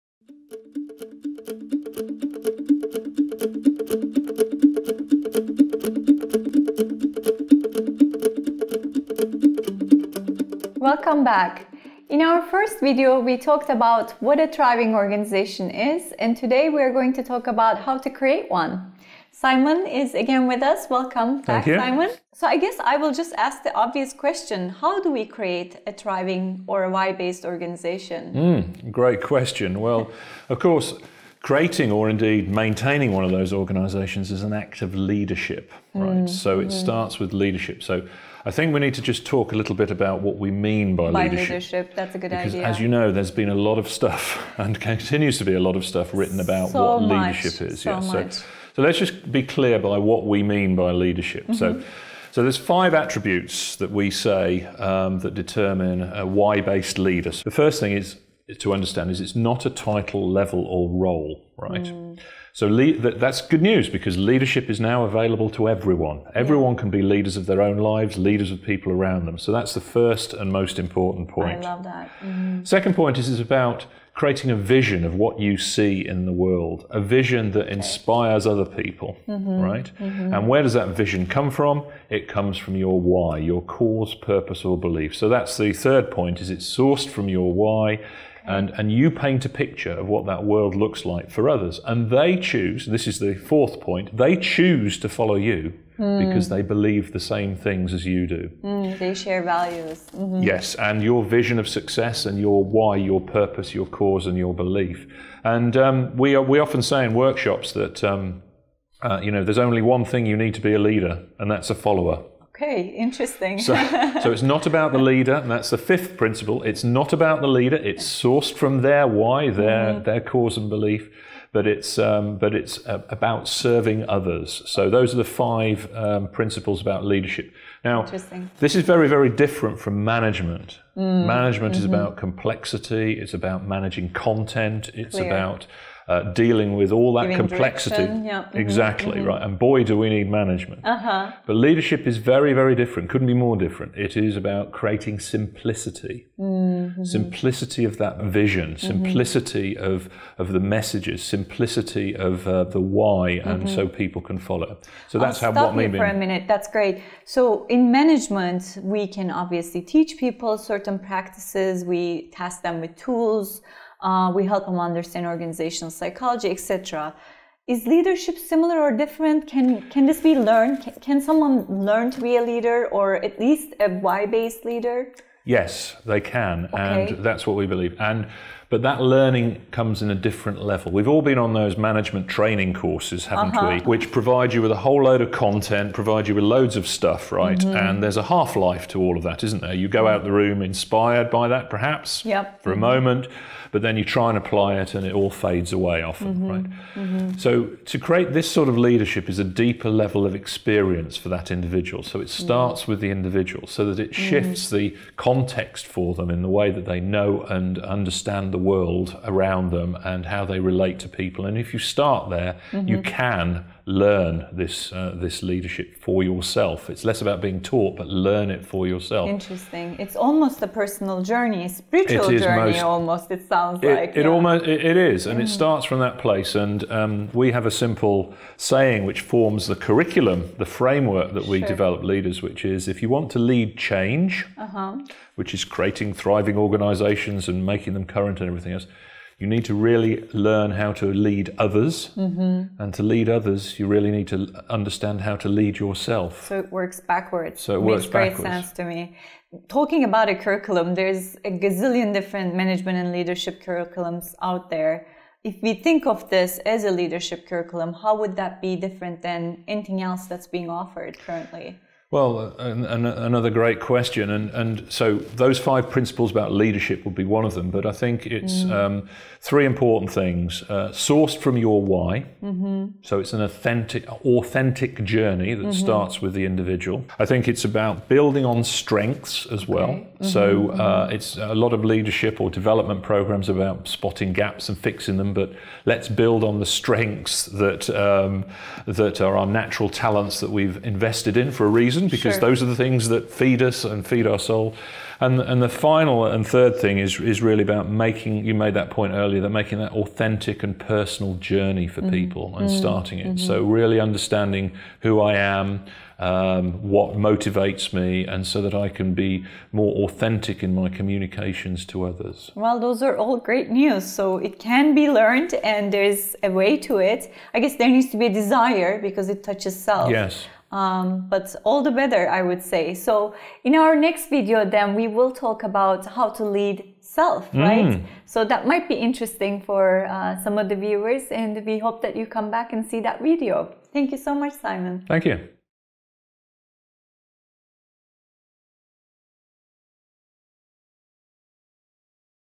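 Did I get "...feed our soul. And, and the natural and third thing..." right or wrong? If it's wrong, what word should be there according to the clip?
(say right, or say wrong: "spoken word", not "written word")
wrong: "final", not "natural".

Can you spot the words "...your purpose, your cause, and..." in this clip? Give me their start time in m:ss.
1:42.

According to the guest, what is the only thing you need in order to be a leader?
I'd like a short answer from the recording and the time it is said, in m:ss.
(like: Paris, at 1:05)
A follower, at 1:51.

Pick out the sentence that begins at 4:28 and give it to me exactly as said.
um, three important things: uh, sourced from your why, mm-hmm.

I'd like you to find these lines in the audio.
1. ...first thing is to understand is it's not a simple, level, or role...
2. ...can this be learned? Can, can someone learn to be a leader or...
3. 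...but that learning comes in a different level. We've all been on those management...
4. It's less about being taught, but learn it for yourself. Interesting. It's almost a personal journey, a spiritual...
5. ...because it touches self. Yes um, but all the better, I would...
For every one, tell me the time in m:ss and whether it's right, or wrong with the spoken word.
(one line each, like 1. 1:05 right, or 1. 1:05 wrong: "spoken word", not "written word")
1. 0:57 wrong: "title", not "simple"
2. 2:49 right
3. 2:58 right
4. 3:36 right
5. 5:19 right.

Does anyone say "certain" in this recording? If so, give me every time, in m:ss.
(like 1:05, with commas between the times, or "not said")
2:40.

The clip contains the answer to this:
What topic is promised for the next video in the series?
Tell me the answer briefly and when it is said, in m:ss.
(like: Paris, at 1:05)
How to lead self, at 5:26.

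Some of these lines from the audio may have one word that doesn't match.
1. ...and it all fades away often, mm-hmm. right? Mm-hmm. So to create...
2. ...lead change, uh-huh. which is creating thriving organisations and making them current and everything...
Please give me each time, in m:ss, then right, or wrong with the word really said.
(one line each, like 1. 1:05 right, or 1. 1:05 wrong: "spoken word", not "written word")
1. 3:14 right
2. 3:53 right.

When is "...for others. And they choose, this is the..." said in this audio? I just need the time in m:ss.
1:31.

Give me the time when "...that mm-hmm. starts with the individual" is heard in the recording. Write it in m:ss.
4:35.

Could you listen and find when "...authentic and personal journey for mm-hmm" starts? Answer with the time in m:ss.
4:59.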